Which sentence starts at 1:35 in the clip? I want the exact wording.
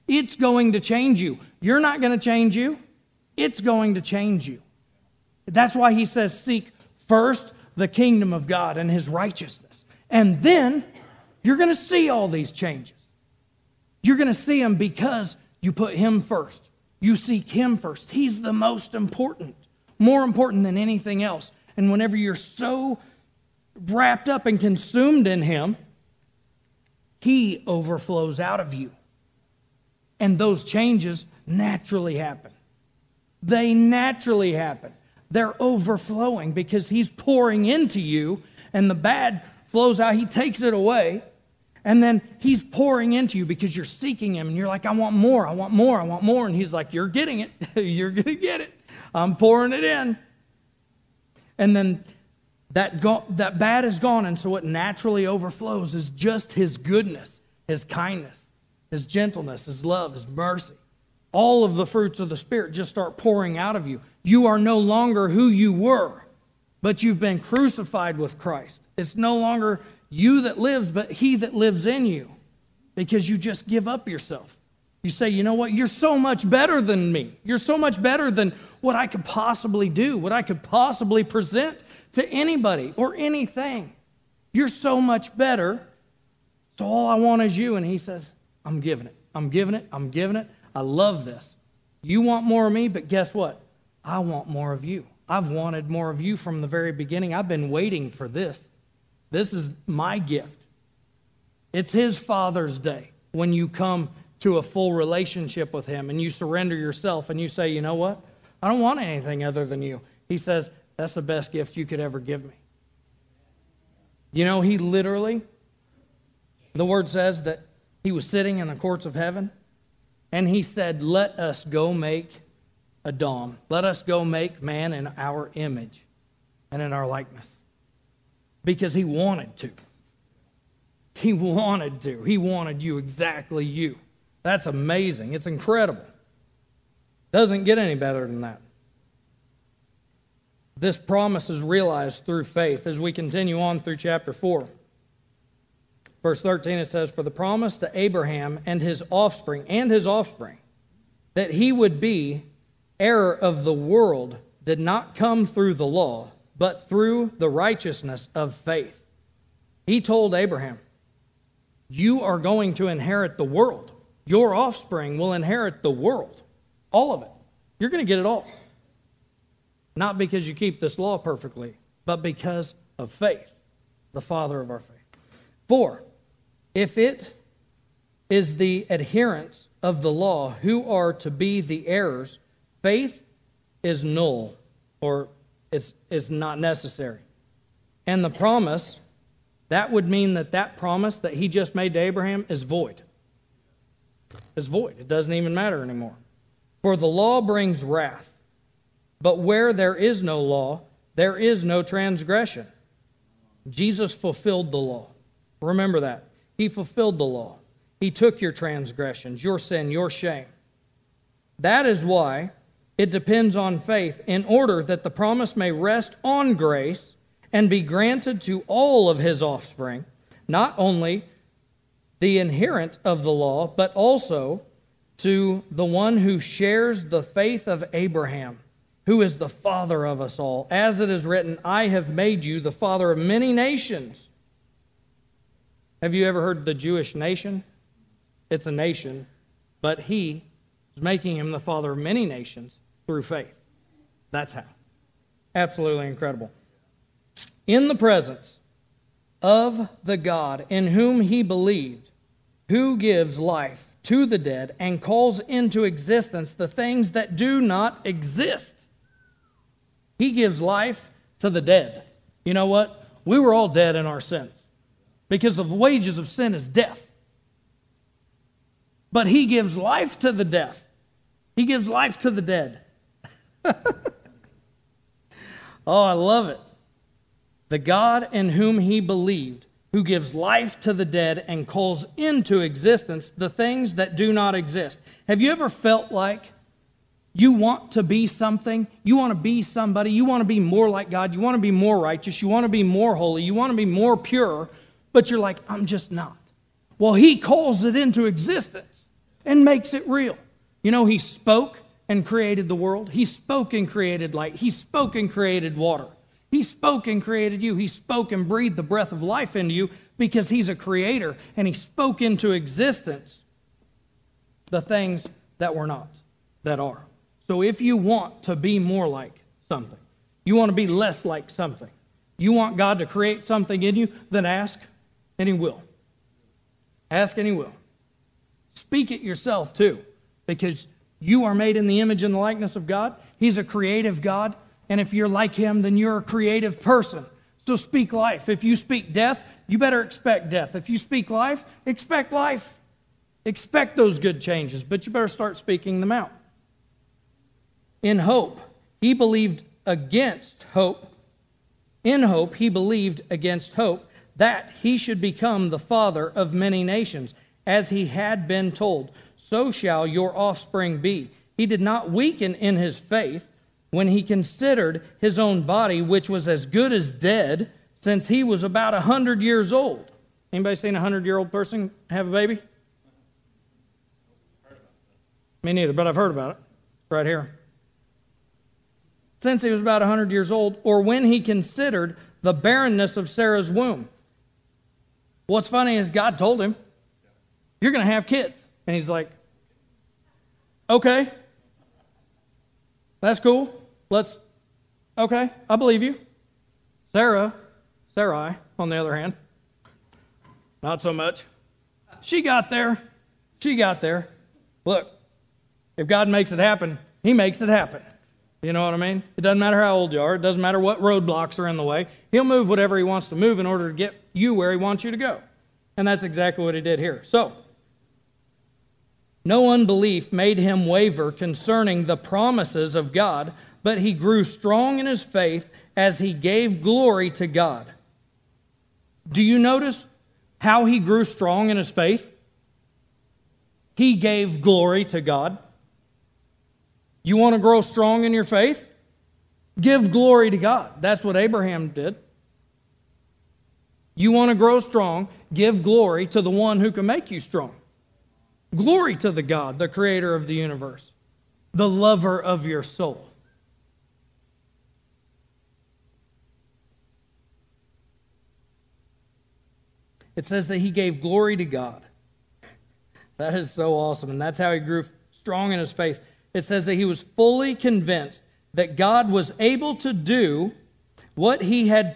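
I've wanted more of you from the very beginning.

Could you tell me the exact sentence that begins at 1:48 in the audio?
I don't want anything other than you.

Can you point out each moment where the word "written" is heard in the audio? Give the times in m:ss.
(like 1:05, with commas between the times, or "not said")
3:51.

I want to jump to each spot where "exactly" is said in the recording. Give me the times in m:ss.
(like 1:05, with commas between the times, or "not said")
2:12, 6:56.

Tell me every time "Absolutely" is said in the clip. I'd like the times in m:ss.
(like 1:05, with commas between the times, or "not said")
4:05.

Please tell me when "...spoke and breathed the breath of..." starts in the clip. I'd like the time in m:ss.
5:07.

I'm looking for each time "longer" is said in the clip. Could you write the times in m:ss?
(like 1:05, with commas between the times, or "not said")
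1:04, 1:09.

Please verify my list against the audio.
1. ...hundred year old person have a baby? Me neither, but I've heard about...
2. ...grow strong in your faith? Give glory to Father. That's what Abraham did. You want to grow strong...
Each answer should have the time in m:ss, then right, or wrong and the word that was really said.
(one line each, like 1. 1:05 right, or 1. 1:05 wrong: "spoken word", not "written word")
1. 6:11 right
2. 7:17 wrong: "God", not "Father".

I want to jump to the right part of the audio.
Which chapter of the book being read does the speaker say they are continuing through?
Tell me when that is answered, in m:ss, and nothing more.
2:23.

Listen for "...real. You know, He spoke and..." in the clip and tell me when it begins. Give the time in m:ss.
5:00.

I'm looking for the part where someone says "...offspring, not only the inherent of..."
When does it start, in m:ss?
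3:39.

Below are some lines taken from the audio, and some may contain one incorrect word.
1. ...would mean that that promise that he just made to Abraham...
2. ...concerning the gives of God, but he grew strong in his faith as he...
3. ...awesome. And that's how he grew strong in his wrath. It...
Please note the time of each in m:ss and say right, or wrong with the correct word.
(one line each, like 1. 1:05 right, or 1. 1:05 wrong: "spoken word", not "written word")
1. 3:09 right
2. 7:01 wrong: "promises", not "gives"
3. 7:43 wrong: "faith", not "wrath".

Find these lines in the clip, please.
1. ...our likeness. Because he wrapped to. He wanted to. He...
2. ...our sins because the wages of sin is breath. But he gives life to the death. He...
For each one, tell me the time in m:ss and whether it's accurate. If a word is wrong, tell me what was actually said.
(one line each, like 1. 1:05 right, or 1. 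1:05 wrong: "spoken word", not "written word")
1. 2:06 wrong: "wanted", not "wrapped"
2. 4:24 wrong: "death", not "breath".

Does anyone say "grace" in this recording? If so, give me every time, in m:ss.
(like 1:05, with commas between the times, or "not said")
3:36.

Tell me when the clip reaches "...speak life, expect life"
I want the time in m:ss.
5:40.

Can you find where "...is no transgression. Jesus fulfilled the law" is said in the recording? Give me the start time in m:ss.
3:21.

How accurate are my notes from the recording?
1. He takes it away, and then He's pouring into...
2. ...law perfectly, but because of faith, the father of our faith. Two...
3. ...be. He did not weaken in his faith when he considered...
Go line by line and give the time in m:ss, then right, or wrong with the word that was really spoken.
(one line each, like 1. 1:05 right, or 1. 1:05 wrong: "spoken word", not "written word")
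1. 0:40 right
2. 2:50 wrong: "Four", not "Two"
3. 6:00 right.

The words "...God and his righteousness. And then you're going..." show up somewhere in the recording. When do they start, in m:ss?
0:08.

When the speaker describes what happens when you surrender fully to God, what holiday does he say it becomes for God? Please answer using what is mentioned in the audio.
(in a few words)
Father's Day.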